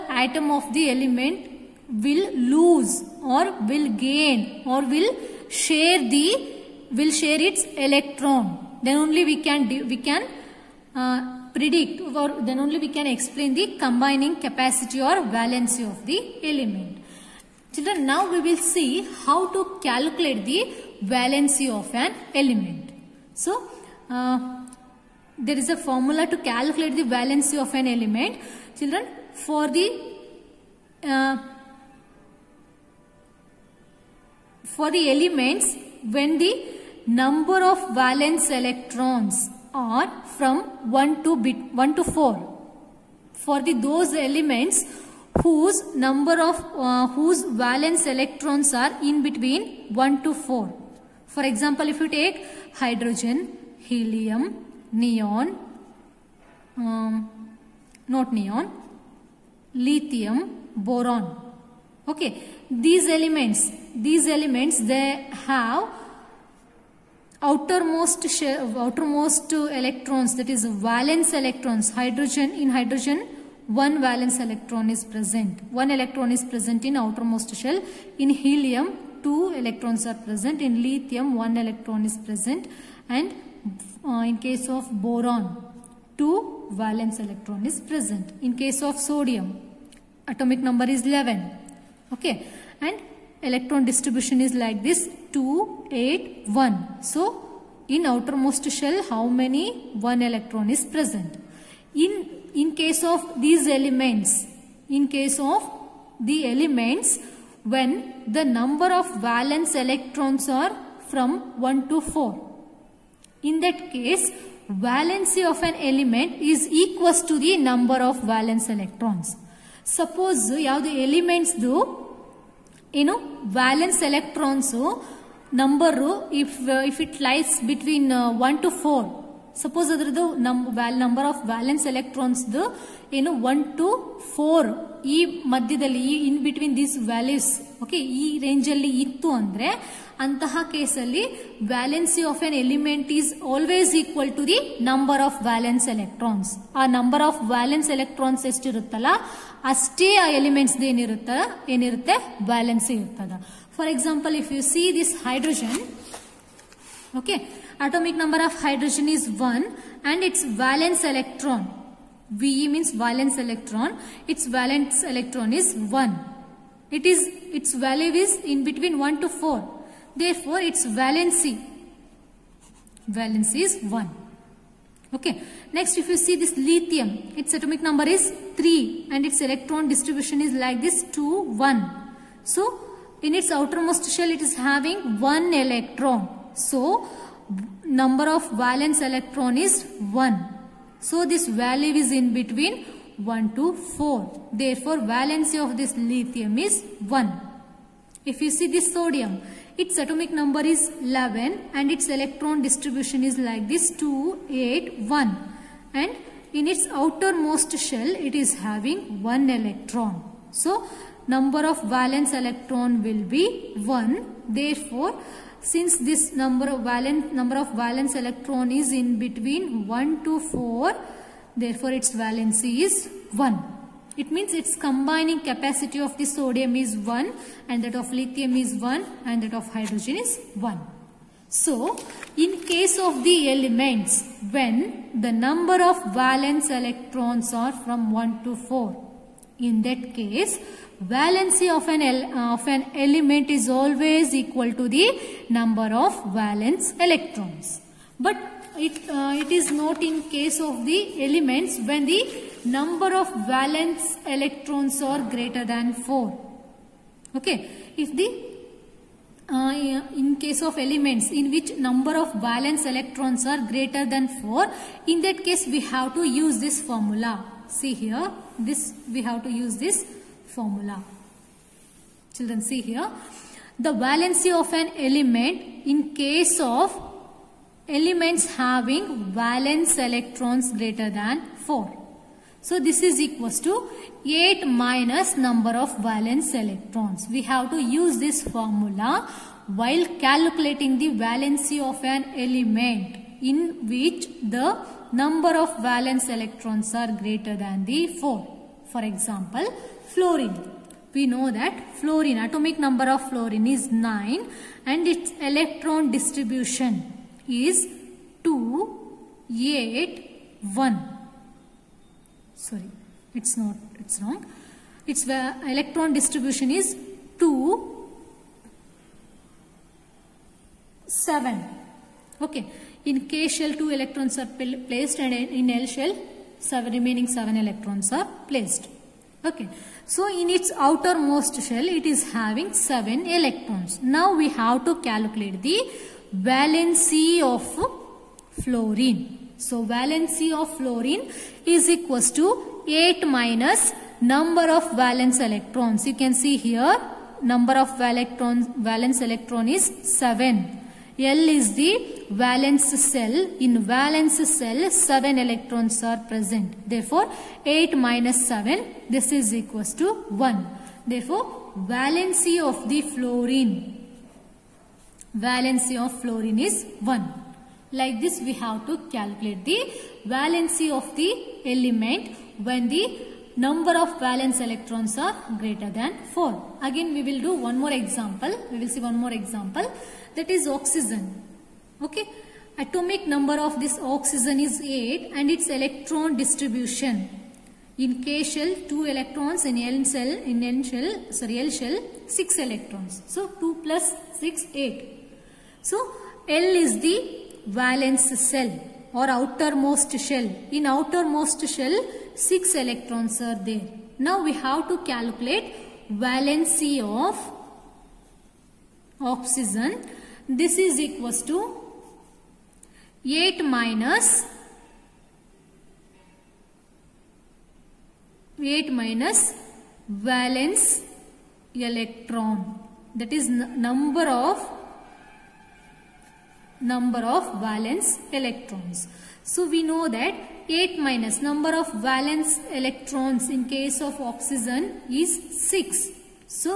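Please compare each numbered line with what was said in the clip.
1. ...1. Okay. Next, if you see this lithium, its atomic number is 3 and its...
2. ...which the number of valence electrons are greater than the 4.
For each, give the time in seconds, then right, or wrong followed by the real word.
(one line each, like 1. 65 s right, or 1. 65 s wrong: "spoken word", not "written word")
1. 173 s right
2. 293 s right.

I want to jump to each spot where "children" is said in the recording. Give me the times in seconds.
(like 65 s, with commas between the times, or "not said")
17 s, 28 s, 272 s.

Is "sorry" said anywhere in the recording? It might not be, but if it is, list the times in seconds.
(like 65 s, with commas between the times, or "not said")
312 s, 391 s.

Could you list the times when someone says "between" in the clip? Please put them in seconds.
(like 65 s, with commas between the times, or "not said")
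49 s, 168 s, 192 s, 219 s.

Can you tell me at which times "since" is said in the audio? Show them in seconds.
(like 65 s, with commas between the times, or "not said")
215 s.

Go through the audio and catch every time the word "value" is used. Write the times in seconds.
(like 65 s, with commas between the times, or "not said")
167 s, 191 s.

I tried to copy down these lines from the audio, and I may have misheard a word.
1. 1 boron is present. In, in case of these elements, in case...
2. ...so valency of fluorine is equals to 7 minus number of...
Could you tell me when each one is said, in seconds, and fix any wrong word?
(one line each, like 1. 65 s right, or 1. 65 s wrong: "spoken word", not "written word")
1. 99 s wrong: "electron", not "boron"
2. 339 s wrong: "8", not "7".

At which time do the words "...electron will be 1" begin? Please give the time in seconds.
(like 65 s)
212 s.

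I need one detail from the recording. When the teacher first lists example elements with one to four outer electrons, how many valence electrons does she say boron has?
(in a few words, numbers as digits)
2.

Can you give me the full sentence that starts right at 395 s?
So L is the valence shell or outermost shell.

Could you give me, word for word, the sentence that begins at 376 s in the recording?
Again we will do one more example.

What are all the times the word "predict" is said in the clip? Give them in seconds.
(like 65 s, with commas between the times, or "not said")
11 s.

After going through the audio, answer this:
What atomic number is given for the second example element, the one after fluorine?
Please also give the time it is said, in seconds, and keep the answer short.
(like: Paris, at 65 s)
8, at 382 s.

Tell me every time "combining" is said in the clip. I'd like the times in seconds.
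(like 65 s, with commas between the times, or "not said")
13 s, 224 s.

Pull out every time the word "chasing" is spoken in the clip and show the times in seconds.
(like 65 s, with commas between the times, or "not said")
not said.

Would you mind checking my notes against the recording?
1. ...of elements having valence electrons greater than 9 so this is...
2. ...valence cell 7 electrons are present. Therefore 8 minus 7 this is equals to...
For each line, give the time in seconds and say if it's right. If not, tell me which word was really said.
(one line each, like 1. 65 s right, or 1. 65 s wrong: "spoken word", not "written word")
1. 276 s wrong: "4", not "9"
2. 353 s right.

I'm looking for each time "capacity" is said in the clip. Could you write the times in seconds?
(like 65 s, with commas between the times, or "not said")
14 s, 225 s.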